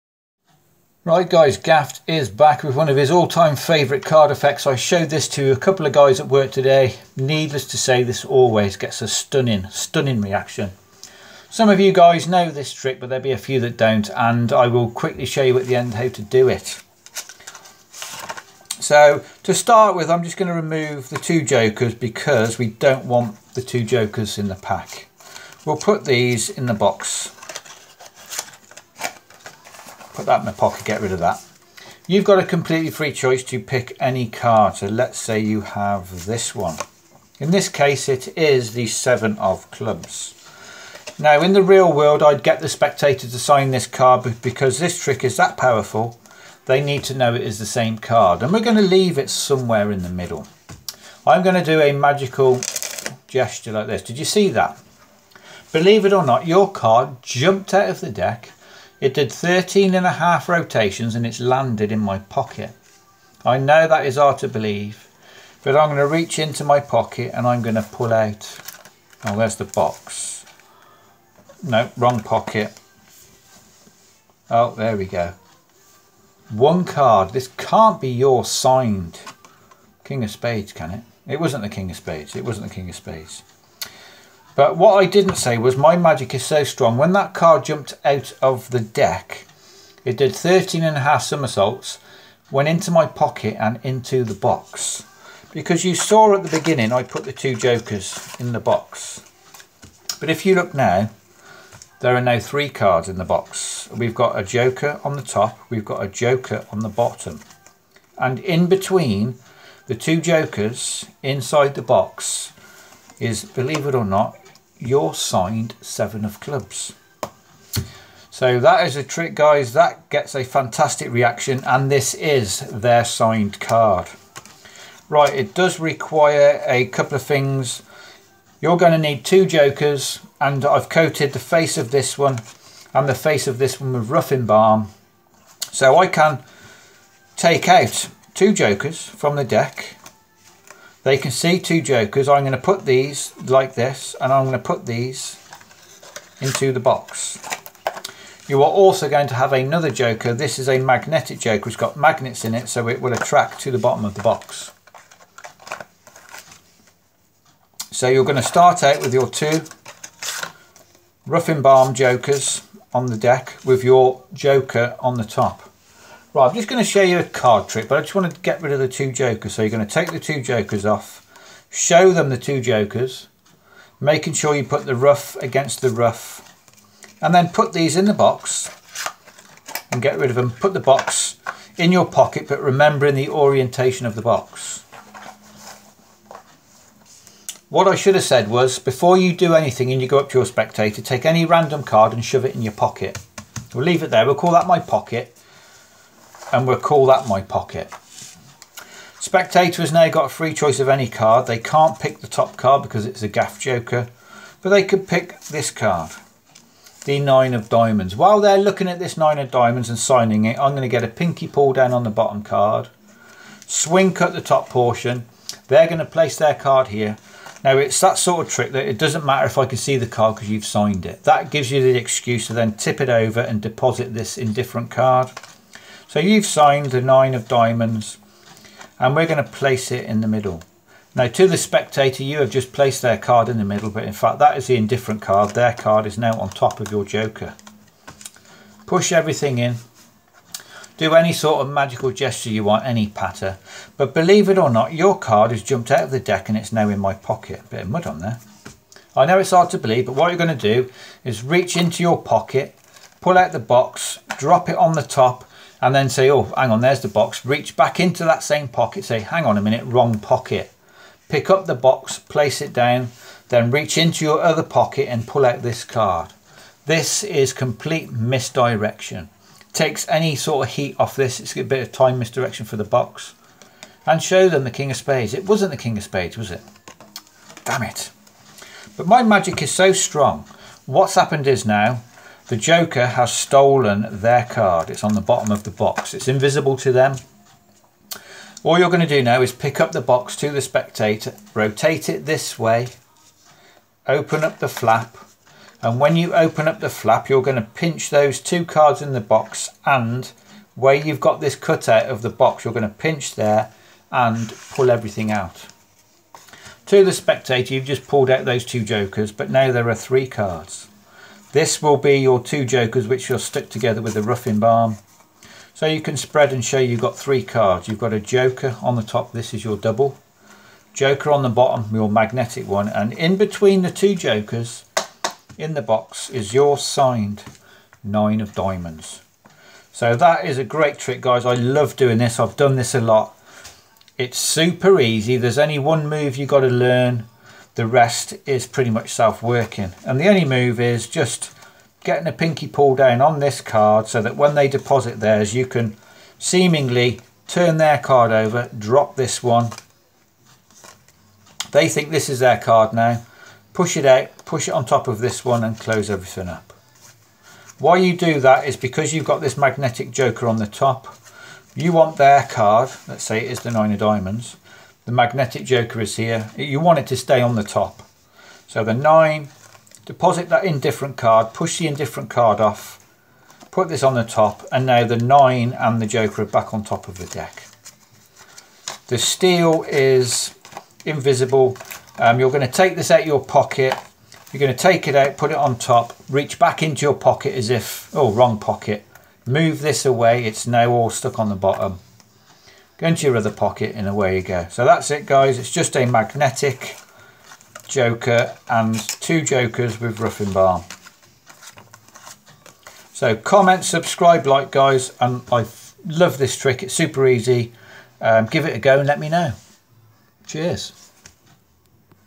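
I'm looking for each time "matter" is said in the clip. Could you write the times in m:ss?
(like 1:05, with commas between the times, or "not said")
3:39.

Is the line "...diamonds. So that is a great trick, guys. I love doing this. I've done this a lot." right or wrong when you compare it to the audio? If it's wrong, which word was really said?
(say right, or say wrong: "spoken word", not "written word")
right.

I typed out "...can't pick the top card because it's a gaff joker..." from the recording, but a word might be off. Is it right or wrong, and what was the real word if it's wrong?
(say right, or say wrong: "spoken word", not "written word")
right.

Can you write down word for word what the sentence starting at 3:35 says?
They're going to place their card here.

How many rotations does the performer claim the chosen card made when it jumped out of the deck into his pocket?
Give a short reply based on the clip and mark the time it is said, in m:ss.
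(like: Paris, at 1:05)
13 and a half, at 0:59.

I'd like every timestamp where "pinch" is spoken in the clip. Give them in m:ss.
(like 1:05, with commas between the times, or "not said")
4:57, 5:02.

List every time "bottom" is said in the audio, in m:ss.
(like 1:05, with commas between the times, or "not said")
1:46, 2:33, 3:32, 4:45, 5:21, 6:31.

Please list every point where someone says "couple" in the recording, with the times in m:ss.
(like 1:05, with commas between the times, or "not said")
0:05, 2:06.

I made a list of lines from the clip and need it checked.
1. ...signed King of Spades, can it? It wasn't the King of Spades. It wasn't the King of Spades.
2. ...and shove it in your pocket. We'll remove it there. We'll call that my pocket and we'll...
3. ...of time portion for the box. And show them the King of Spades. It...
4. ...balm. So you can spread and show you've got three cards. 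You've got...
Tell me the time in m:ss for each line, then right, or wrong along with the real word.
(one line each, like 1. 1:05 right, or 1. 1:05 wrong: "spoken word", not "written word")
1. 1:18 right
2. 3:12 wrong: "leave", not "remove"
3. 4:31 wrong: "misdirection", not "portion"
4. 5:14 right.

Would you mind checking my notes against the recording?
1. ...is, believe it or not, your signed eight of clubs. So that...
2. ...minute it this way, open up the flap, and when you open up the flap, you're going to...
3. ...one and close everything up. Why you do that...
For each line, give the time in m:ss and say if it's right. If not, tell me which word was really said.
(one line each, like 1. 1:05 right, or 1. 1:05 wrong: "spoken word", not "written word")
1. 1:53 wrong: "seven", not "eight"
2. 4:51 wrong: "rotate", not "minute"
3. 5:55 right.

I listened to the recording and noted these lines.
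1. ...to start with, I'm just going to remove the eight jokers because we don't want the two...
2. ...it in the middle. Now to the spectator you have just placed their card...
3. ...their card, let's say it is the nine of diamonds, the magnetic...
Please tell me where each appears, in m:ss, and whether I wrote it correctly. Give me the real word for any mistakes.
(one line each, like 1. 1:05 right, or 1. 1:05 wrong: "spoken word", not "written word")
1. 0:19 wrong: "two", not "eight"
2. 3:49 right
3. 6:02 right.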